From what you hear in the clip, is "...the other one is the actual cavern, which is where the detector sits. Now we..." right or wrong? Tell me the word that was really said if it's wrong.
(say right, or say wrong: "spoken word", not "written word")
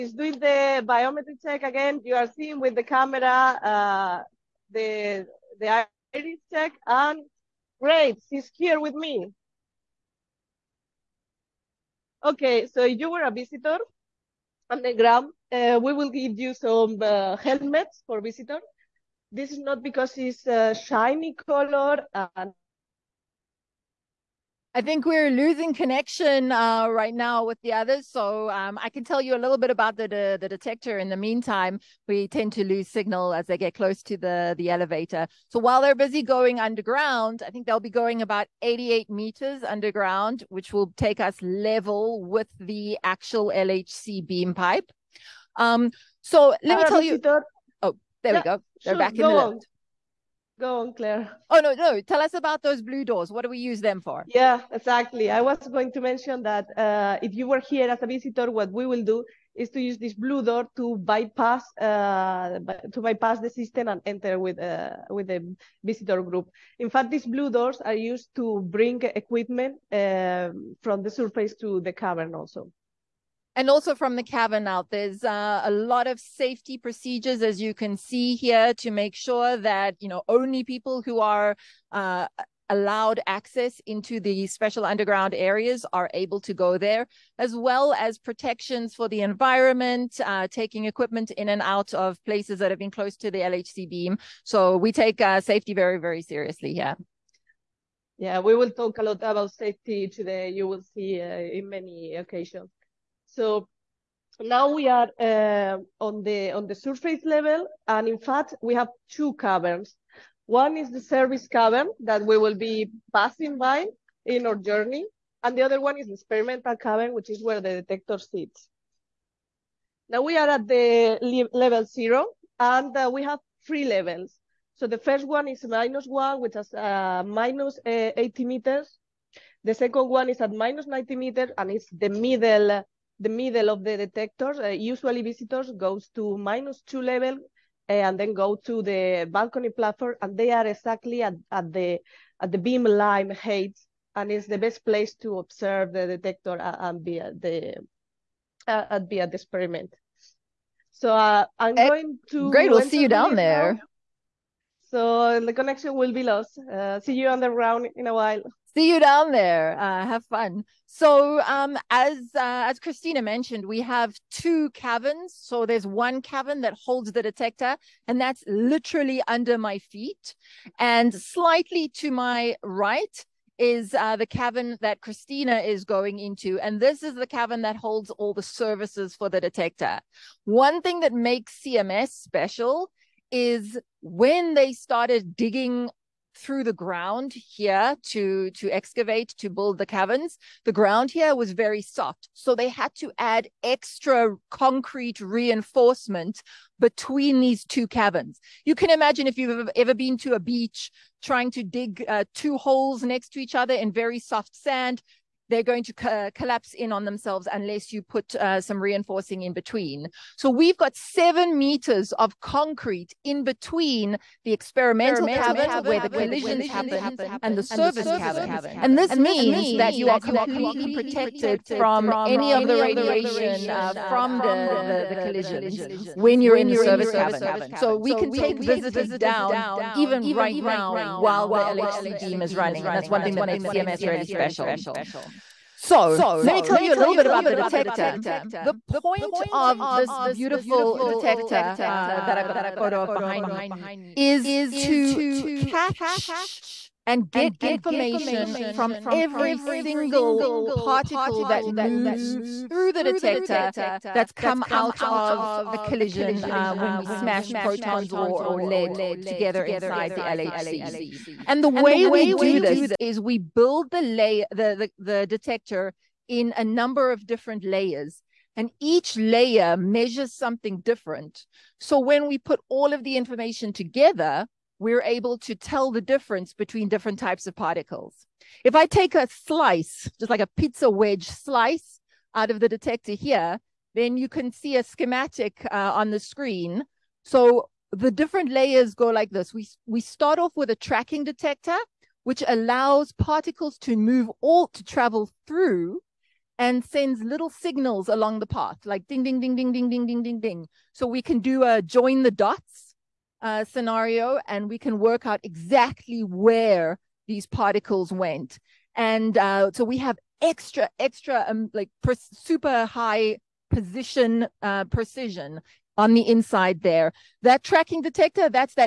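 wrong: "experimental", not "actual".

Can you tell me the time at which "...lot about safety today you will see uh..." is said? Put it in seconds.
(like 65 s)
99 s.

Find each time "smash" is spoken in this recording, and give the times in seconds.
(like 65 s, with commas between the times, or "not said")
257 s.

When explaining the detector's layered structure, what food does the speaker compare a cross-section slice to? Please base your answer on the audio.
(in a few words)
Pizza wedge.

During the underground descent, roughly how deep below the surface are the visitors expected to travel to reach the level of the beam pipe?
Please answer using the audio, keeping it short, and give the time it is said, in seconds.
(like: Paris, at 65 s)
88 meters, at 38 s.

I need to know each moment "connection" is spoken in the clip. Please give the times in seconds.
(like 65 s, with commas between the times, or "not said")
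25 s, 155 s.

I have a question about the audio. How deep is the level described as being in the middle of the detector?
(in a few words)
90 meters.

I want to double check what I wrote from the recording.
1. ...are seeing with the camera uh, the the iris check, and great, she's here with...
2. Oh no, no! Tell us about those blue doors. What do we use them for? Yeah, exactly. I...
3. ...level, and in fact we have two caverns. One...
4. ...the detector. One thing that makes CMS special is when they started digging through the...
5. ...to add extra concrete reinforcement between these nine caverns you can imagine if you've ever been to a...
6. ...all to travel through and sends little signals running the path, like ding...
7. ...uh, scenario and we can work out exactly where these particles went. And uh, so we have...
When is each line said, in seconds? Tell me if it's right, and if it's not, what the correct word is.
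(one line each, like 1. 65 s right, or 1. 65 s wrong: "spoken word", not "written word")
1. 2 s right
2. 51 s right
3. 107 s right
4. 179 s right
5. 192 s wrong: "two", not "nine"
6. 294 s wrong: "along", not "running"
7. 303 s right.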